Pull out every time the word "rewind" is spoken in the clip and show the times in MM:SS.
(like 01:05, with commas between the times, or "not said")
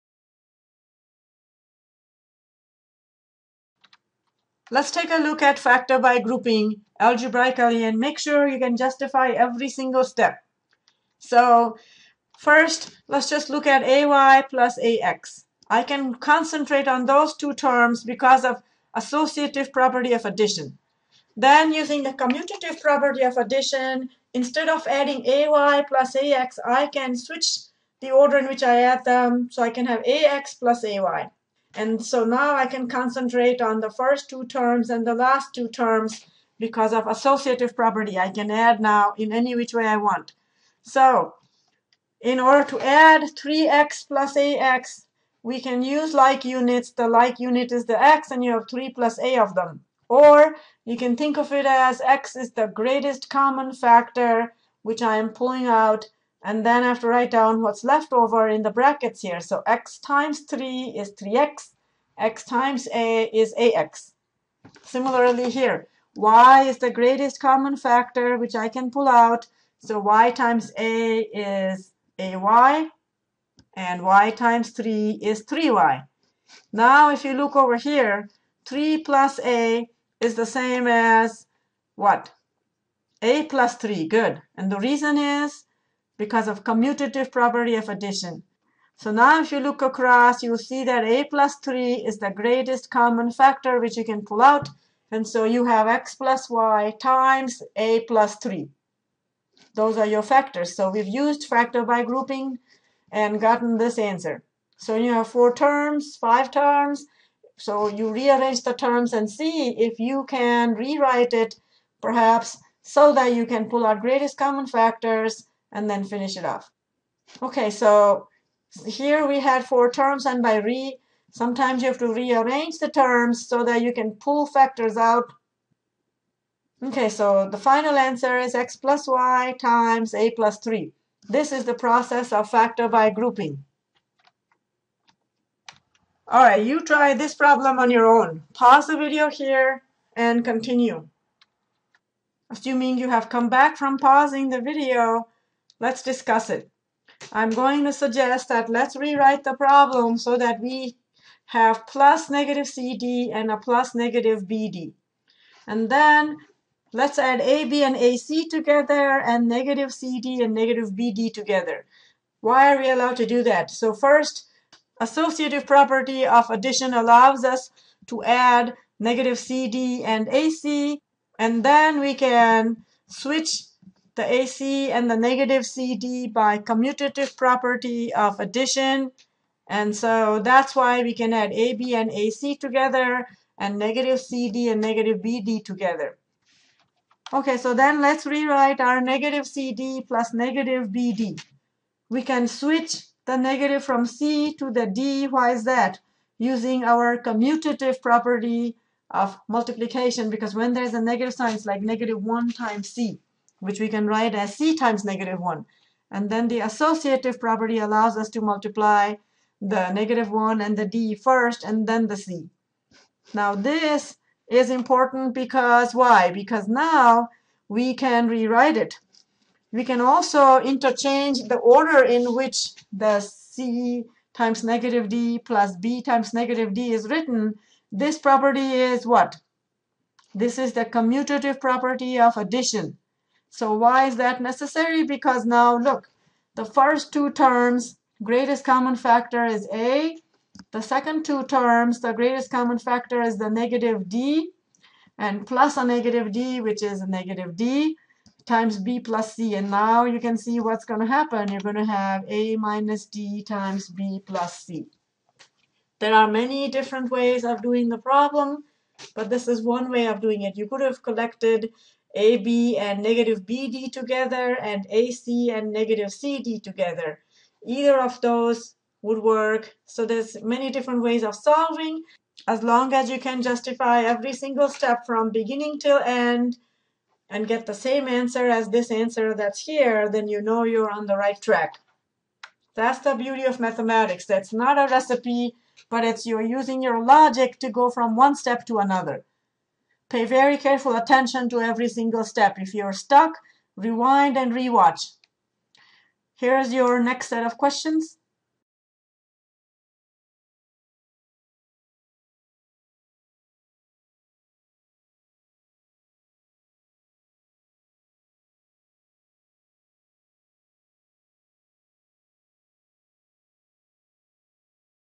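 04:53.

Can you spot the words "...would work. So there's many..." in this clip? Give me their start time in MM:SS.
04:29.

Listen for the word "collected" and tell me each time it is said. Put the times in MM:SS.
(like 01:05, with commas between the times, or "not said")
04:21.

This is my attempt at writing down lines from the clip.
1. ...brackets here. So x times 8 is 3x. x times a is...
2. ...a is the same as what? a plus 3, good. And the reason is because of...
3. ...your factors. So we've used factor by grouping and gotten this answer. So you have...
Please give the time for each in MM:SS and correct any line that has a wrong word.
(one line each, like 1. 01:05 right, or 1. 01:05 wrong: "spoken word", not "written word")
1. 00:58 wrong: "3", not "8"
2. 01:19 right
3. 01:40 right.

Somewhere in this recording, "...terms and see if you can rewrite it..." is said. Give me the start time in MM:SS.
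01:48.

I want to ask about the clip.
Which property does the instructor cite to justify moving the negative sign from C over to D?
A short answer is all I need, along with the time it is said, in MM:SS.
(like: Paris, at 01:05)
Commutative property of multiplication, at 03:17.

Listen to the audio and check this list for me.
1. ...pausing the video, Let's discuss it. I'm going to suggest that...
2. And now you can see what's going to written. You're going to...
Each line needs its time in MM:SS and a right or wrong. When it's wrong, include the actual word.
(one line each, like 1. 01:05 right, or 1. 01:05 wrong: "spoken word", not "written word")
1. 02:23 right
2. 04:09 wrong: "happen", not "written".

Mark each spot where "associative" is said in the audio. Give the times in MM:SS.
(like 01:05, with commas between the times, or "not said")
00:18, 00:37, 02:44, 03:26.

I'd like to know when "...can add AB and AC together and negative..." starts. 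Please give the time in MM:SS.
03:01.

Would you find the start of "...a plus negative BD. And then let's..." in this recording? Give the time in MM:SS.
02:33.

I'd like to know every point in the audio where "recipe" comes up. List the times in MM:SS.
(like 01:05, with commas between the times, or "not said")
04:44.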